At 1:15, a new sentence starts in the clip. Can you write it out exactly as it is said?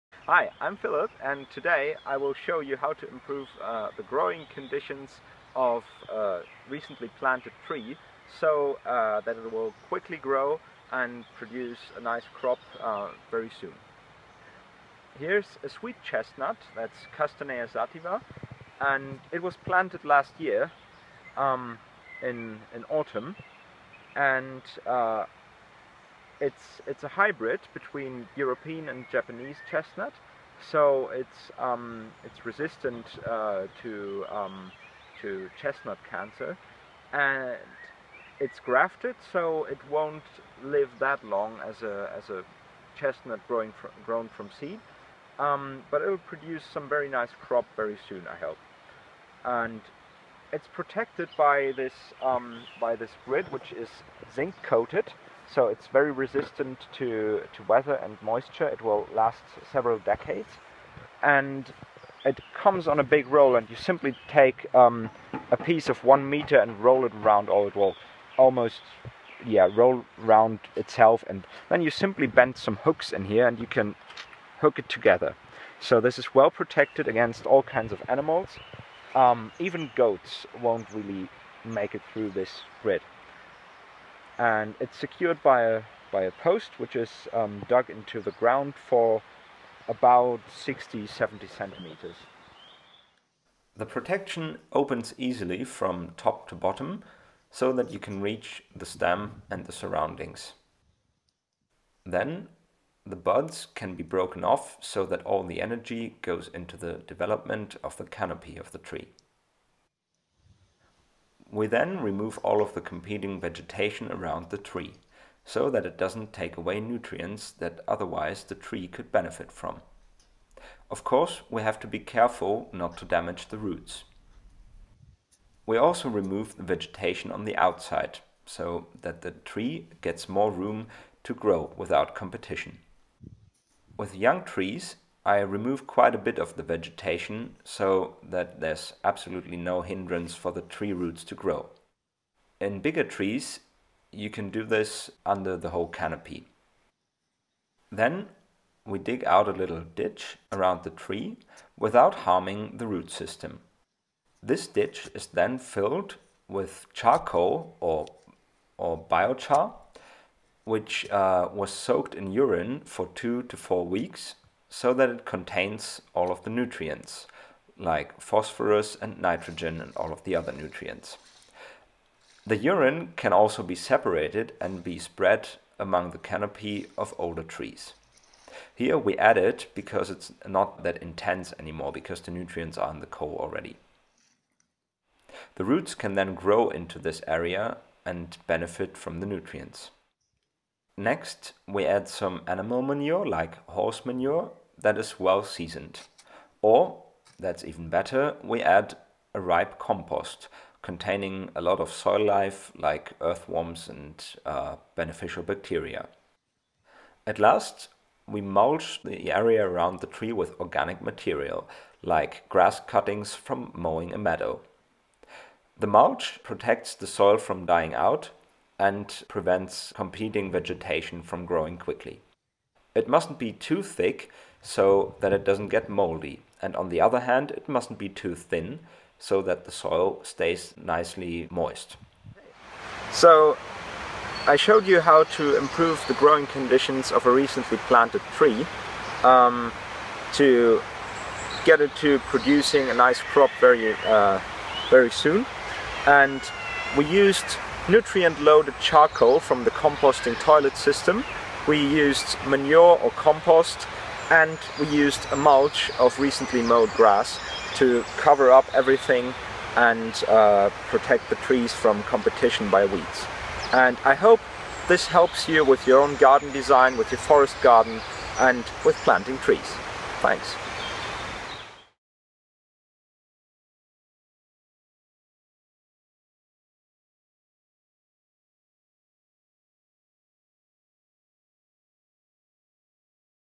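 So this is well protected against all kinds of animals.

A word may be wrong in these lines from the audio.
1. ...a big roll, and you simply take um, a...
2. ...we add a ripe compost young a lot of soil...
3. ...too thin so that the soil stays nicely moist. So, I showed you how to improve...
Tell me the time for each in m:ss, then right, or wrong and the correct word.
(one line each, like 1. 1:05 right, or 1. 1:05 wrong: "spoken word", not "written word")
1. 1:02 right
2. 3:18 wrong: "containing", not "young"
3. 3:48 right.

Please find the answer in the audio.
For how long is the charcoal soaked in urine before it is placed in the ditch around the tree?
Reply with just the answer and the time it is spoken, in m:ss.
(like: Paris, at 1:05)
2 to 4 weeks, at 2:43.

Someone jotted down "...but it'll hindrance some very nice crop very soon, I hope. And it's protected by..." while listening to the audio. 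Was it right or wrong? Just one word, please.
wrong.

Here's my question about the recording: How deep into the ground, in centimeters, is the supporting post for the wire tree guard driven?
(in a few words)
60-70 centimeters.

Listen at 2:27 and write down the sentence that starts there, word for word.
Then we dig out a little ditch around the tree without harming the root system.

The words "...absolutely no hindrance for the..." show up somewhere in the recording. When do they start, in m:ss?
2:19.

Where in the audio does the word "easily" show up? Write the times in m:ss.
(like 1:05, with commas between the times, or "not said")
1:35.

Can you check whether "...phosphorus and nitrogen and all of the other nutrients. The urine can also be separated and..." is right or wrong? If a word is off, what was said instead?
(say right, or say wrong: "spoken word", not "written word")
right.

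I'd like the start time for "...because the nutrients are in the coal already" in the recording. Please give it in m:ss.
3:01.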